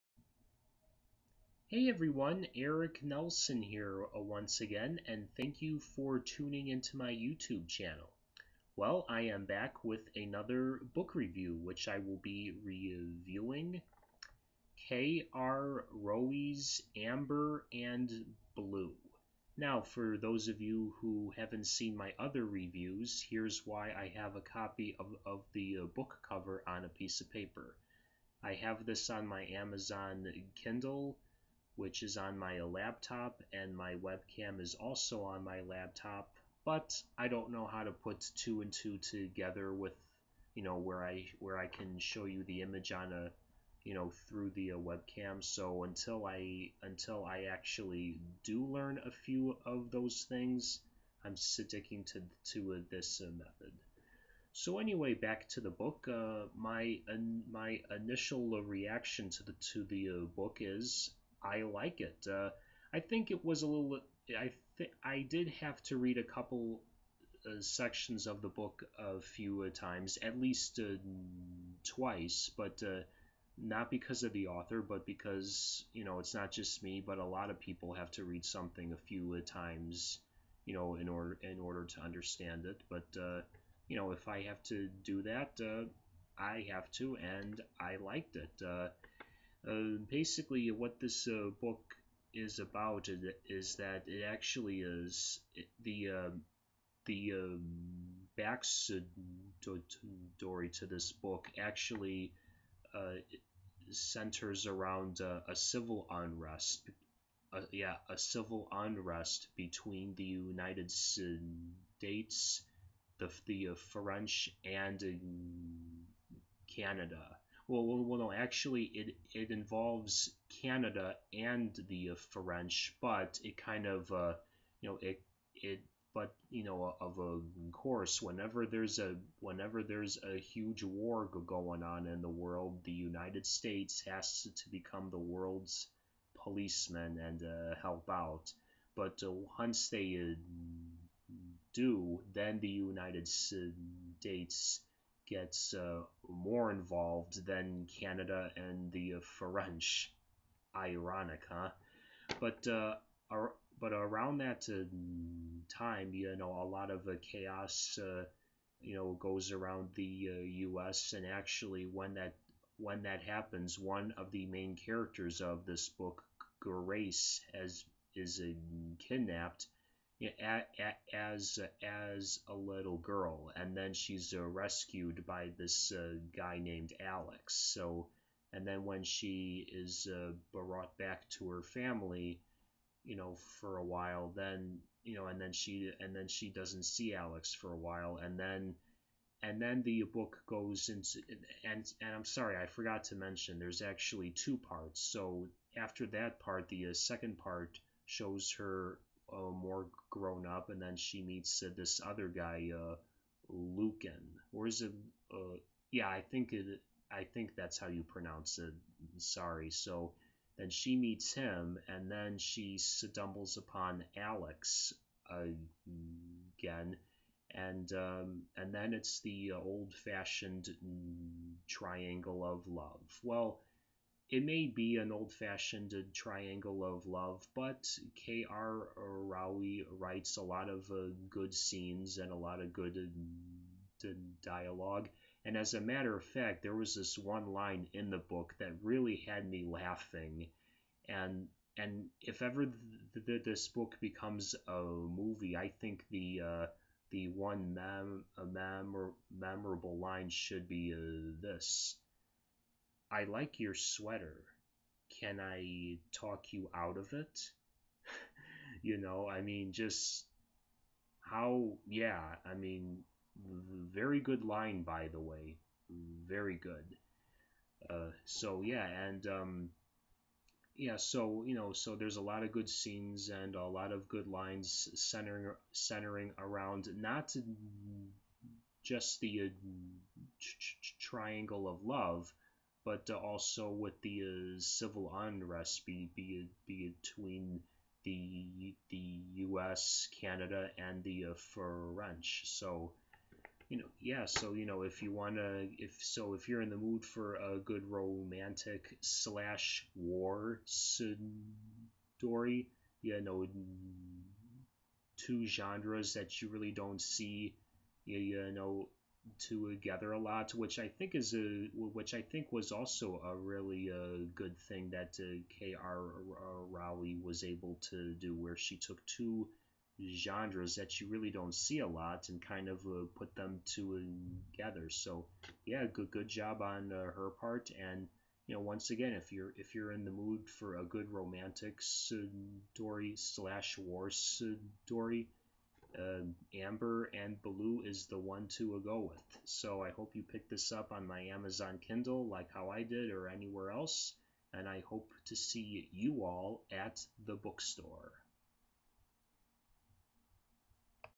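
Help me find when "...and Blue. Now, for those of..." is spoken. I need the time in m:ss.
0:17.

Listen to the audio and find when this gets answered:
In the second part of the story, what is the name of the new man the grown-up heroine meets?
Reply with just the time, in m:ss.
3:23.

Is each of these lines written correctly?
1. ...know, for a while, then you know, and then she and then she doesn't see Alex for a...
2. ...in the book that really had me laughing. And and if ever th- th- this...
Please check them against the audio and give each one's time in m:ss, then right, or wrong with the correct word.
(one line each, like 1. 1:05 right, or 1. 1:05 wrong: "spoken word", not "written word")
1. 3:03 right
2. 3:57 right.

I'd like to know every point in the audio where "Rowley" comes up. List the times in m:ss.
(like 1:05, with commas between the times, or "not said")
3:48, 5:16.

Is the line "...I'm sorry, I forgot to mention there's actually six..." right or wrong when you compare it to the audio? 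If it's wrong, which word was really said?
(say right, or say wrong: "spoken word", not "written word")
wrong: "two", not "six".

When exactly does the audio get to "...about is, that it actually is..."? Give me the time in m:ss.
1:32.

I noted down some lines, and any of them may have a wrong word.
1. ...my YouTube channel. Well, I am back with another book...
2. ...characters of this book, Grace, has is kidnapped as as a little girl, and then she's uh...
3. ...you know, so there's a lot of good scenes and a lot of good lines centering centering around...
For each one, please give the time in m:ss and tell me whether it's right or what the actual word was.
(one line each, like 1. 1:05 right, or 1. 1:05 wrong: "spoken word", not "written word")
1. 0:06 right
2. 2:44 right
3. 4:31 right.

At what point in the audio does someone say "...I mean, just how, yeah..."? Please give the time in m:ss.
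4:19.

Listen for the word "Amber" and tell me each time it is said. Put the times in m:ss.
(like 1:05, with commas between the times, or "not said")
0:16, 5:36.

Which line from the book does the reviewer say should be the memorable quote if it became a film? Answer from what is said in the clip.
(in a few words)
I like your sweater.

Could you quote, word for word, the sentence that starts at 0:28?
I have this on my Amazon Kindle which is on my laptop, and my webcam is also on my laptop.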